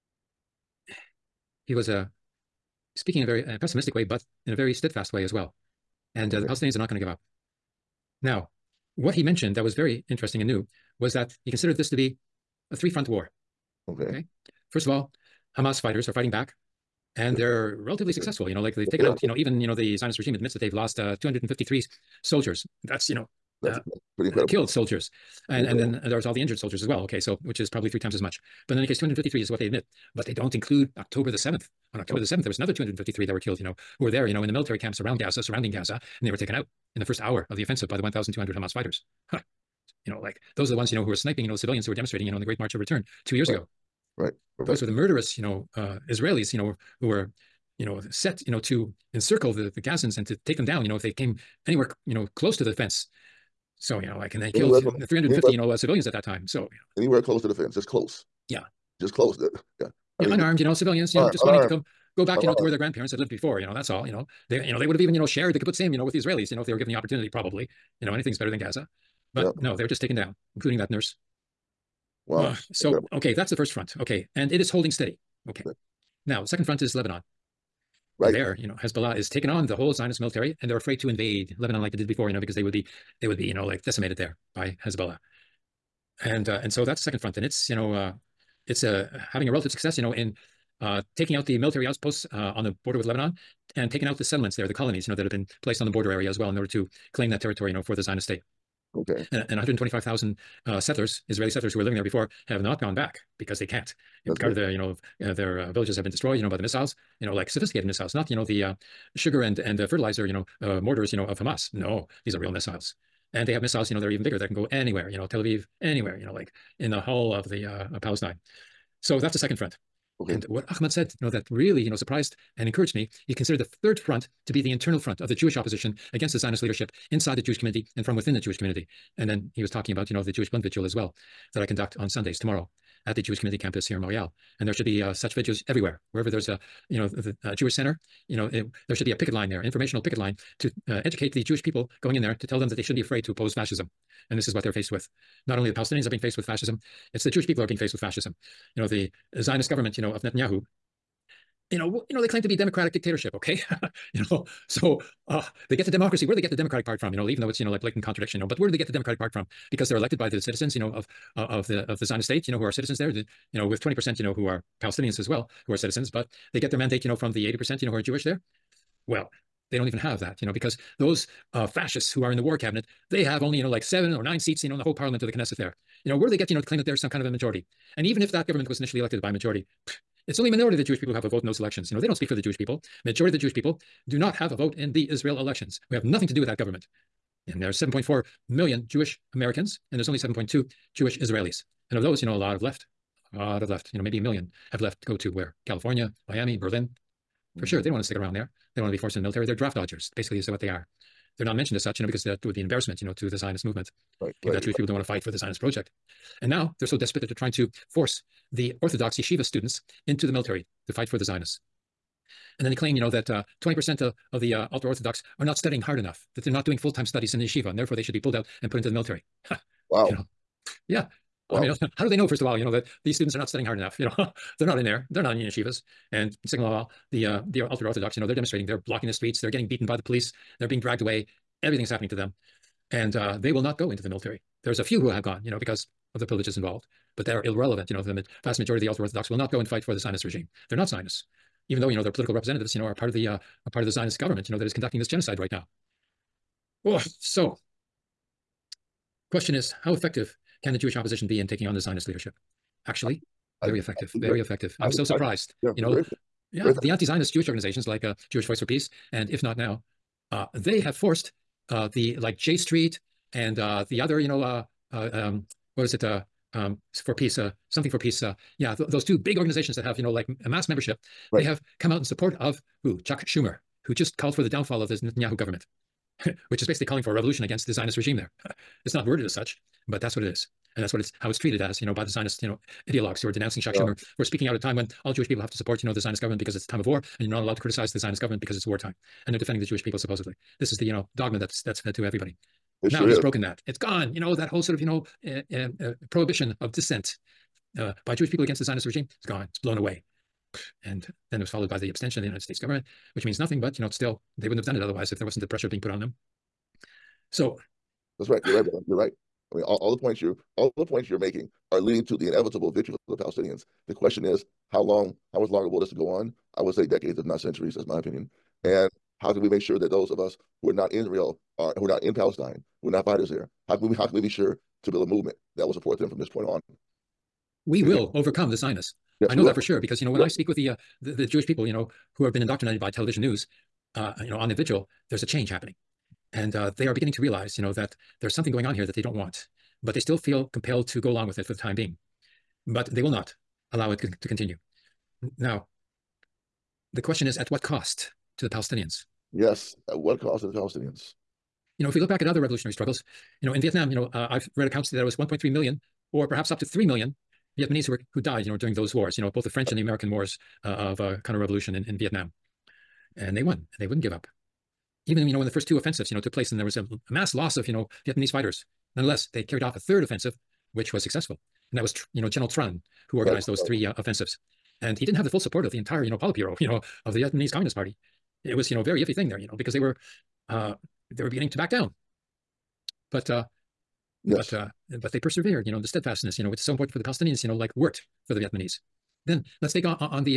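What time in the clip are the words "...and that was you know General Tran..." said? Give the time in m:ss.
6:11.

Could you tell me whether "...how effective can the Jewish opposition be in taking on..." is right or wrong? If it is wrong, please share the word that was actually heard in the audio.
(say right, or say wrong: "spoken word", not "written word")
right.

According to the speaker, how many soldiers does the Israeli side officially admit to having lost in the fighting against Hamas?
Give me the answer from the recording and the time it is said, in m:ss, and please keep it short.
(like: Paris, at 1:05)
253, at 0:21.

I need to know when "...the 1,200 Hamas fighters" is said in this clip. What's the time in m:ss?
0:37.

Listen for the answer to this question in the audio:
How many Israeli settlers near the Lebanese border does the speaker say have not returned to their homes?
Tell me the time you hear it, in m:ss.
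1:39.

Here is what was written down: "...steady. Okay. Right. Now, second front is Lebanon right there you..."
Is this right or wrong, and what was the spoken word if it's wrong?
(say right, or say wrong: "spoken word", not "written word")
right.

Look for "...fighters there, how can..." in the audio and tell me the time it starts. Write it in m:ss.
5:23.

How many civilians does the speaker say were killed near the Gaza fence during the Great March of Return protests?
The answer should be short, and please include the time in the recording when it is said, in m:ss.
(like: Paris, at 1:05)
350, at 0:54.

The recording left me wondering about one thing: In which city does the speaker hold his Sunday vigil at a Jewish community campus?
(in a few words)
Montreal.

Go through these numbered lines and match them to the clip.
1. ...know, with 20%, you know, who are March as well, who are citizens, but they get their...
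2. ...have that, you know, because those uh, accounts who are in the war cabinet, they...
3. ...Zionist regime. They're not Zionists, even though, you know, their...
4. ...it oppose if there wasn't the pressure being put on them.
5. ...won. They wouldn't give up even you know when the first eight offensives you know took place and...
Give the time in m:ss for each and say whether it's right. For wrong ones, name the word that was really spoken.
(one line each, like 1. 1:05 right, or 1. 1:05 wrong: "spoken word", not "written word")
1. 2:43 wrong: "Palestinians", not "March"
2. 2:49 wrong: "fascists", not "accounts"
3. 3:59 right
4. 5:04 wrong: "otherwise", not "oppose"
5. 6:03 wrong: "two", not "eight".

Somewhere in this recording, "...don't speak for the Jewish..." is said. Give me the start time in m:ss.
3:02.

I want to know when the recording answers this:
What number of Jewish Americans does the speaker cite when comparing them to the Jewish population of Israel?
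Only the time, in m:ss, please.
3:07.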